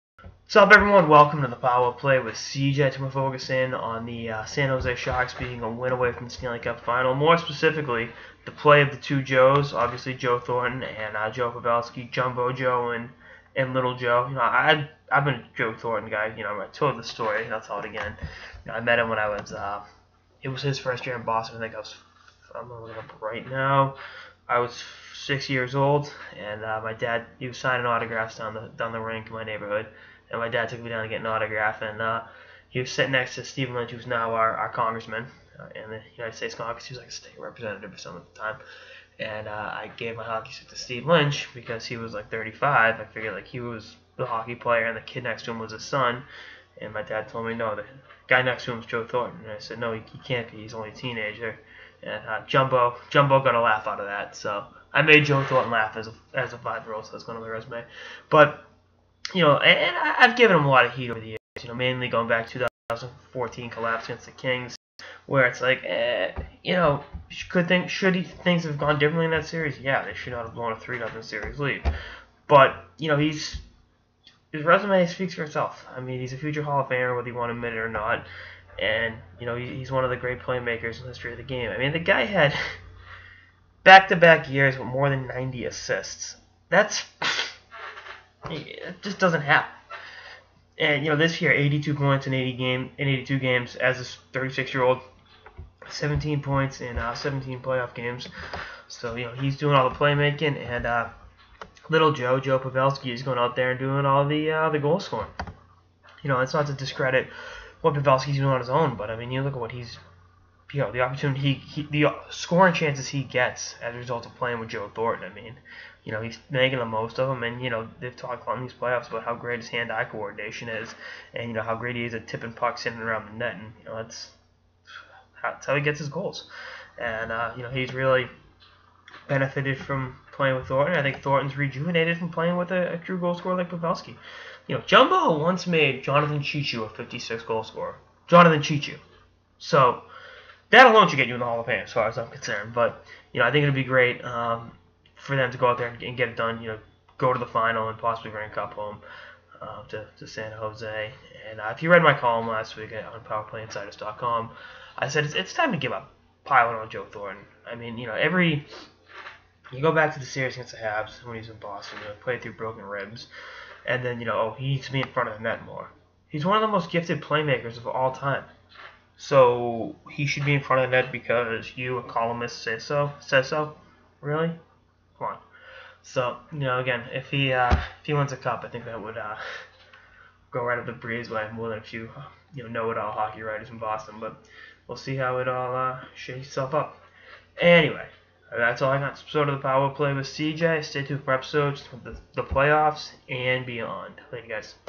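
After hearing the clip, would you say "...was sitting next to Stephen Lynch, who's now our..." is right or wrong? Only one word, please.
right.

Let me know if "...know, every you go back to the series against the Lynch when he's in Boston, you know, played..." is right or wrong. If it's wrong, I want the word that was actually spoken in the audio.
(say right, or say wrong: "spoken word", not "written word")
wrong: "Habs", not "Lynch".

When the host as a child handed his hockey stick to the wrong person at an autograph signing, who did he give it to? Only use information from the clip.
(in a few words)
Stephen Lynch.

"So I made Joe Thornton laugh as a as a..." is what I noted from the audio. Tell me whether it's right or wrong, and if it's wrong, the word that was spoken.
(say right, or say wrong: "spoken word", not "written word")
right.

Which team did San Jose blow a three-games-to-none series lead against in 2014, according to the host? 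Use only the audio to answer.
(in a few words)
the Kings.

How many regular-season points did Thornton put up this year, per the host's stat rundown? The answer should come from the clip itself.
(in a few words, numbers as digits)
82.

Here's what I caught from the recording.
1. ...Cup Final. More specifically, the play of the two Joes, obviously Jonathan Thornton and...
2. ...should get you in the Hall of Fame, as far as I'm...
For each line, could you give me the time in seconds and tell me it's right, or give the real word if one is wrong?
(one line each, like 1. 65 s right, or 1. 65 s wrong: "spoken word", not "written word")
1. 6 s wrong: "Joe", not "Jonathan"
2. 141 s right.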